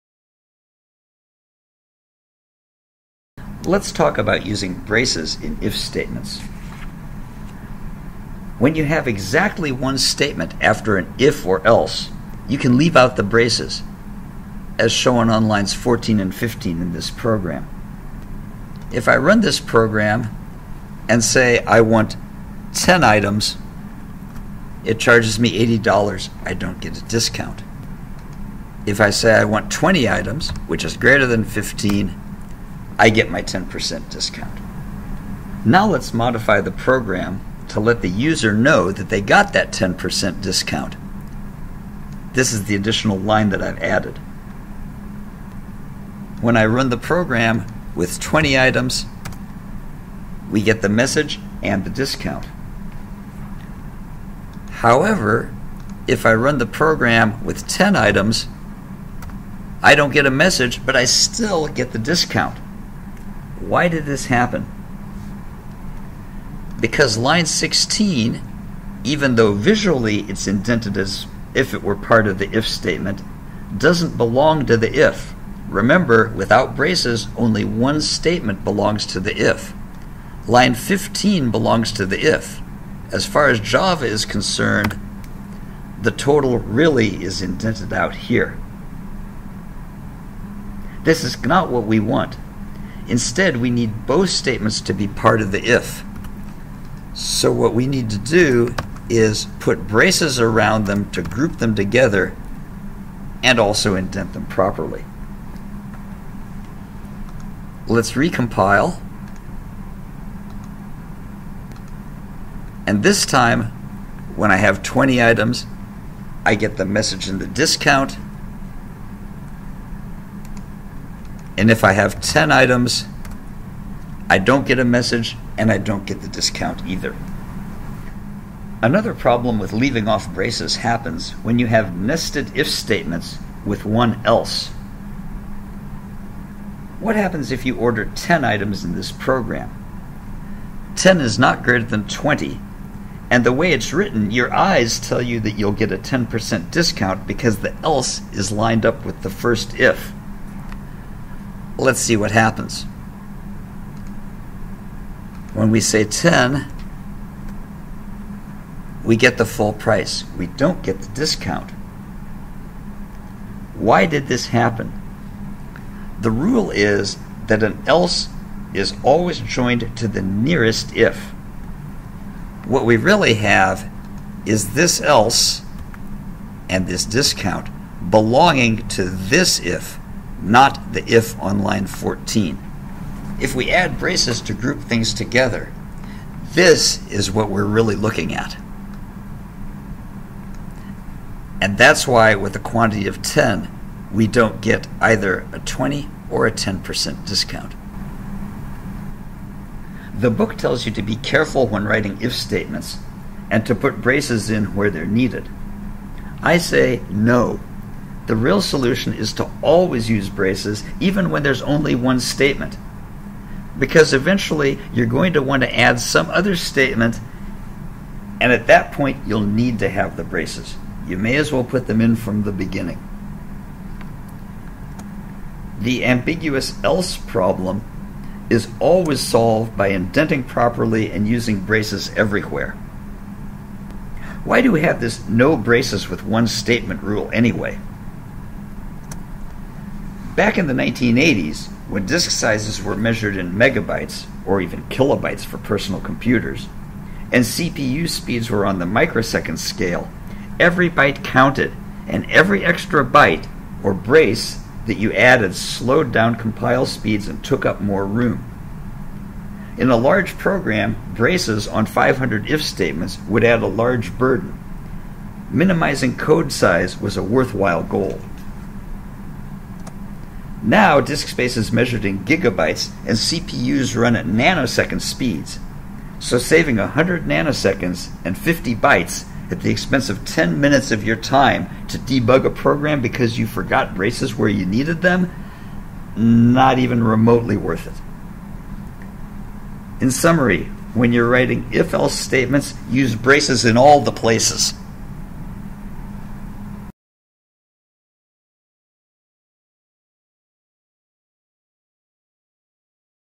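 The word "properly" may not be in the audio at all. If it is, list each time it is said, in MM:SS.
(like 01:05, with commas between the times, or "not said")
01:44, 03:50.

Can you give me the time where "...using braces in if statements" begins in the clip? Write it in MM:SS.
00:04.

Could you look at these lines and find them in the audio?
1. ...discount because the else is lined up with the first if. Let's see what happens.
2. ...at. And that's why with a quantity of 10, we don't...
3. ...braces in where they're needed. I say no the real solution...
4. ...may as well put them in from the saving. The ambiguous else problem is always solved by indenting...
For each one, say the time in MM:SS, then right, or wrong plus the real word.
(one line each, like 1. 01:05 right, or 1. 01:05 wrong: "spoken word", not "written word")
1. 02:26 right
2. 03:08 right
3. 03:24 right
4. 03:41 wrong: "beginning", not "saving".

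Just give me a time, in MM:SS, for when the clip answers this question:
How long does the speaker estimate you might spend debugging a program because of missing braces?
04:40.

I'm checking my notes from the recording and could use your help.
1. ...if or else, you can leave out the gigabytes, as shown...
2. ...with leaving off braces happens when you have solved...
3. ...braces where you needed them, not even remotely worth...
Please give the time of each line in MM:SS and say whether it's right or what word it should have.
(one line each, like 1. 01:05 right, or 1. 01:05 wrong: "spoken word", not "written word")
1. 00:11 wrong: "braces", not "gigabytes"
2. 02:09 wrong: "nested", not "solved"
3. 04:43 right.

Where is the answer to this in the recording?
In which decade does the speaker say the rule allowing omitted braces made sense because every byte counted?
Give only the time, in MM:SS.
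04:00.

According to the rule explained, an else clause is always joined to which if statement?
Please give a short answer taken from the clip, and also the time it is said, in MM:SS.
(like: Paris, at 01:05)
the nearest if, at 02:50.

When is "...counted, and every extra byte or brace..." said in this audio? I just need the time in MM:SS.
04:11.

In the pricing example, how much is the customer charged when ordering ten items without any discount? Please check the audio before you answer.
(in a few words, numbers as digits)
$80.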